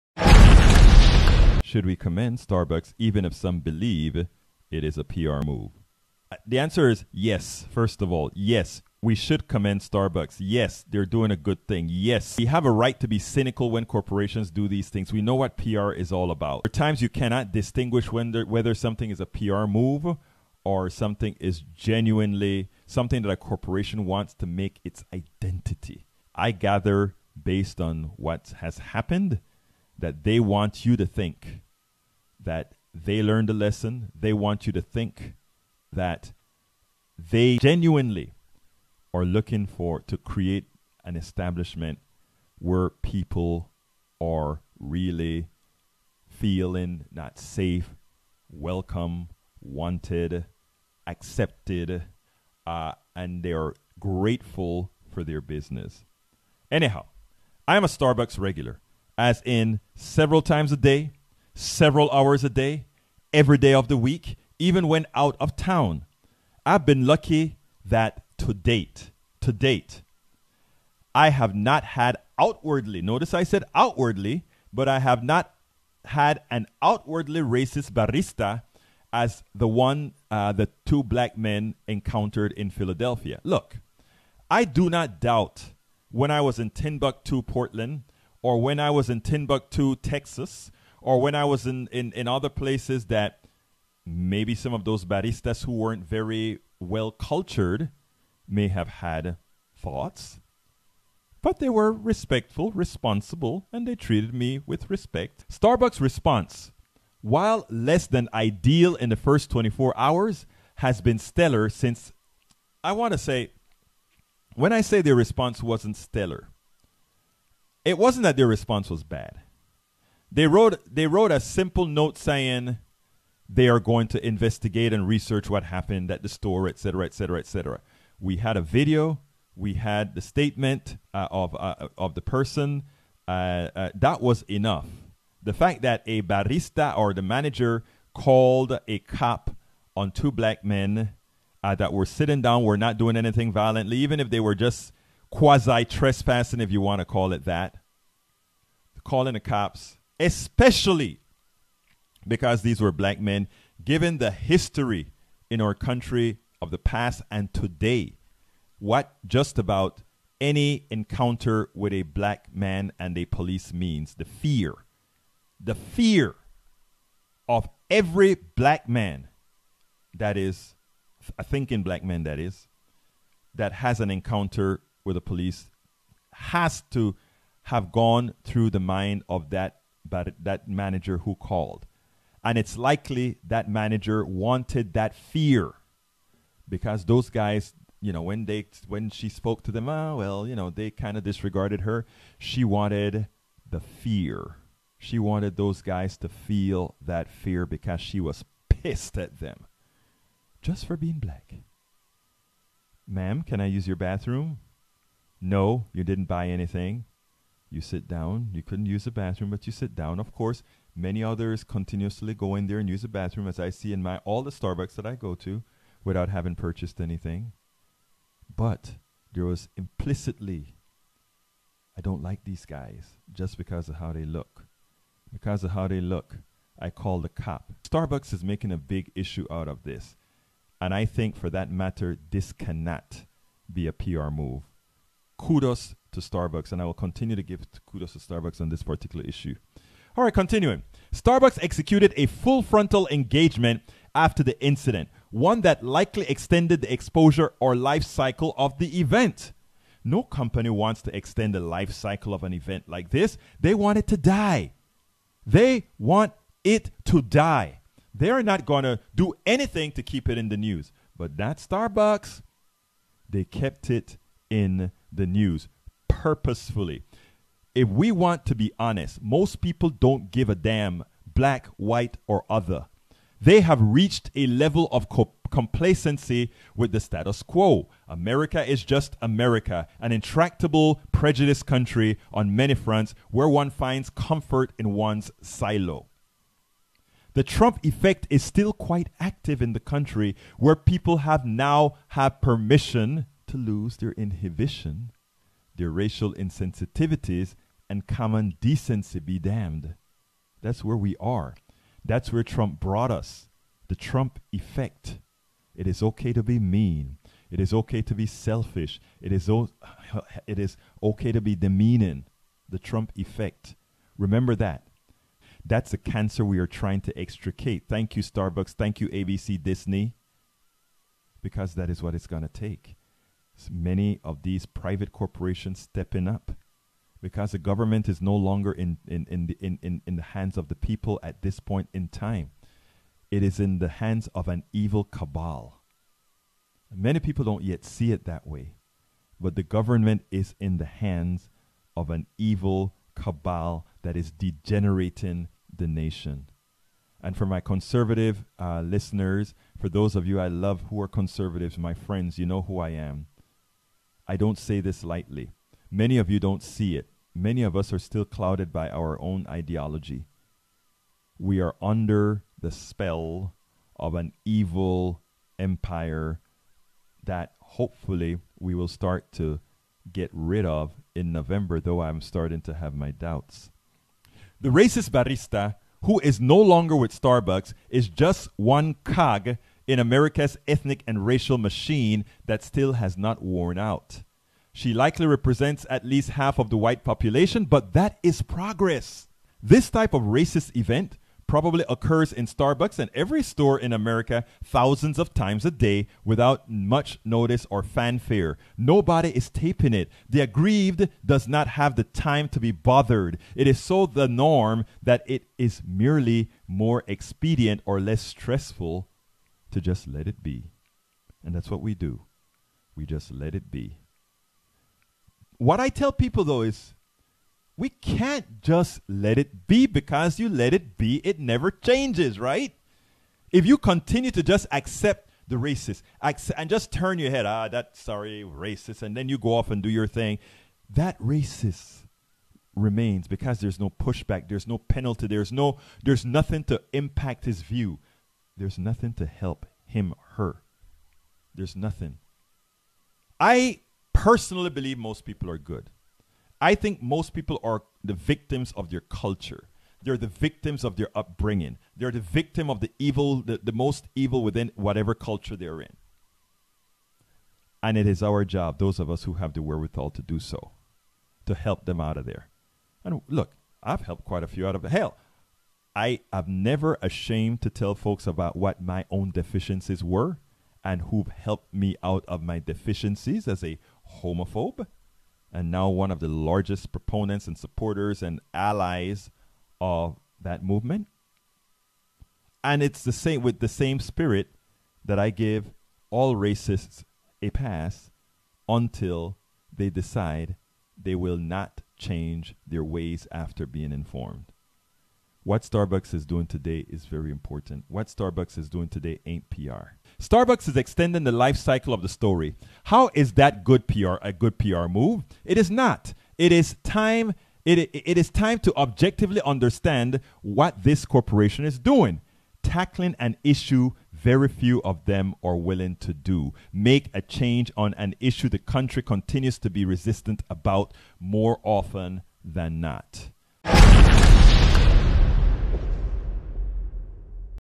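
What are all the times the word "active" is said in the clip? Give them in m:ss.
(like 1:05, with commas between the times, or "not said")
4:49.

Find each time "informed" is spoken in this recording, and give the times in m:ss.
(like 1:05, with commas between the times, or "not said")
8:13.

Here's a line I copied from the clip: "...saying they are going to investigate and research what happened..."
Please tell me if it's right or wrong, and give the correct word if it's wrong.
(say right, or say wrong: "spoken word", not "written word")
right.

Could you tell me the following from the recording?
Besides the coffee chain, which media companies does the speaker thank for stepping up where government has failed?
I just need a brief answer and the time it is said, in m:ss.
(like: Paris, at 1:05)
ABC, Disney, at 5:19.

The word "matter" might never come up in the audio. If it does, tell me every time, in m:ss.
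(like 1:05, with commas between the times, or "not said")
3:51.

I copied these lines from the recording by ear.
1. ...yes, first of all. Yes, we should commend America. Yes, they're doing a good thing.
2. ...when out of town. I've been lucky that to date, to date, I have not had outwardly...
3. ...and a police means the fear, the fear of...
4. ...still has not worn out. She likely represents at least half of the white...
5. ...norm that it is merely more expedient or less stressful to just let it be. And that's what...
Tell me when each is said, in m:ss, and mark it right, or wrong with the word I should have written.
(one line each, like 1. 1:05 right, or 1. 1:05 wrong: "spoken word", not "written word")
1. 0:07 wrong: "Starbucks", not "America"
2. 1:04 right
3. 2:42 right
4. 6:22 right
5. 6:44 right.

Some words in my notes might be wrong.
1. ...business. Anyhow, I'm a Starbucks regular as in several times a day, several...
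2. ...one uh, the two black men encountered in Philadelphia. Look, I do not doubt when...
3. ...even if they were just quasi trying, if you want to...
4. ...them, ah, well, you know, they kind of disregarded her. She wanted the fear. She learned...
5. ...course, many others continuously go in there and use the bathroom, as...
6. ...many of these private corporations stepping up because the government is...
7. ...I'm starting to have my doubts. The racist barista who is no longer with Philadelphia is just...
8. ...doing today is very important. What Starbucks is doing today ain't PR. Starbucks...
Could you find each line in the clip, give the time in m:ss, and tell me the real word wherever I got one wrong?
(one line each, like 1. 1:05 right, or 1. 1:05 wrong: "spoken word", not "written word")
1. 0:55 right
2. 1:19 right
3. 2:23 wrong: "trespassing", not "trying"
4. 3:09 wrong: "wanted", not "learned"
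5. 3:30 right
6. 5:23 right
7. 6:12 wrong: "Starbucks", not "Philadelphia"
8. 8:16 right.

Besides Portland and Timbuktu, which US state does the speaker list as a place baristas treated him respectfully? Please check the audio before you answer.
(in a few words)
Texas.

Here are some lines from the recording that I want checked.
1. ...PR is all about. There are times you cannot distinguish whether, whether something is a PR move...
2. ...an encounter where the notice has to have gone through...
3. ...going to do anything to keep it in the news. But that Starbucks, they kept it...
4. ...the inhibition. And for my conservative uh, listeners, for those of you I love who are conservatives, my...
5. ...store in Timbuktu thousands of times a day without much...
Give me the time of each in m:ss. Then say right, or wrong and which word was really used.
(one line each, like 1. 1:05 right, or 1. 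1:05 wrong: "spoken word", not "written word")
1. 0:15 right
2. 2:53 wrong: "police", not "notice"
3. 4:18 right
4. 5:45 wrong: "nation", not "inhibition"
5. 6:33 wrong: "America", not "Timbuktu".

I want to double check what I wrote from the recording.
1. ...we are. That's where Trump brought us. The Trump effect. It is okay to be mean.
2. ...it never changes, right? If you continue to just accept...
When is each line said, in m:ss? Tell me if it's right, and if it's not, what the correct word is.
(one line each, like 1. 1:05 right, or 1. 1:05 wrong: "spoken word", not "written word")
1. 5:00 right
2. 7:01 right.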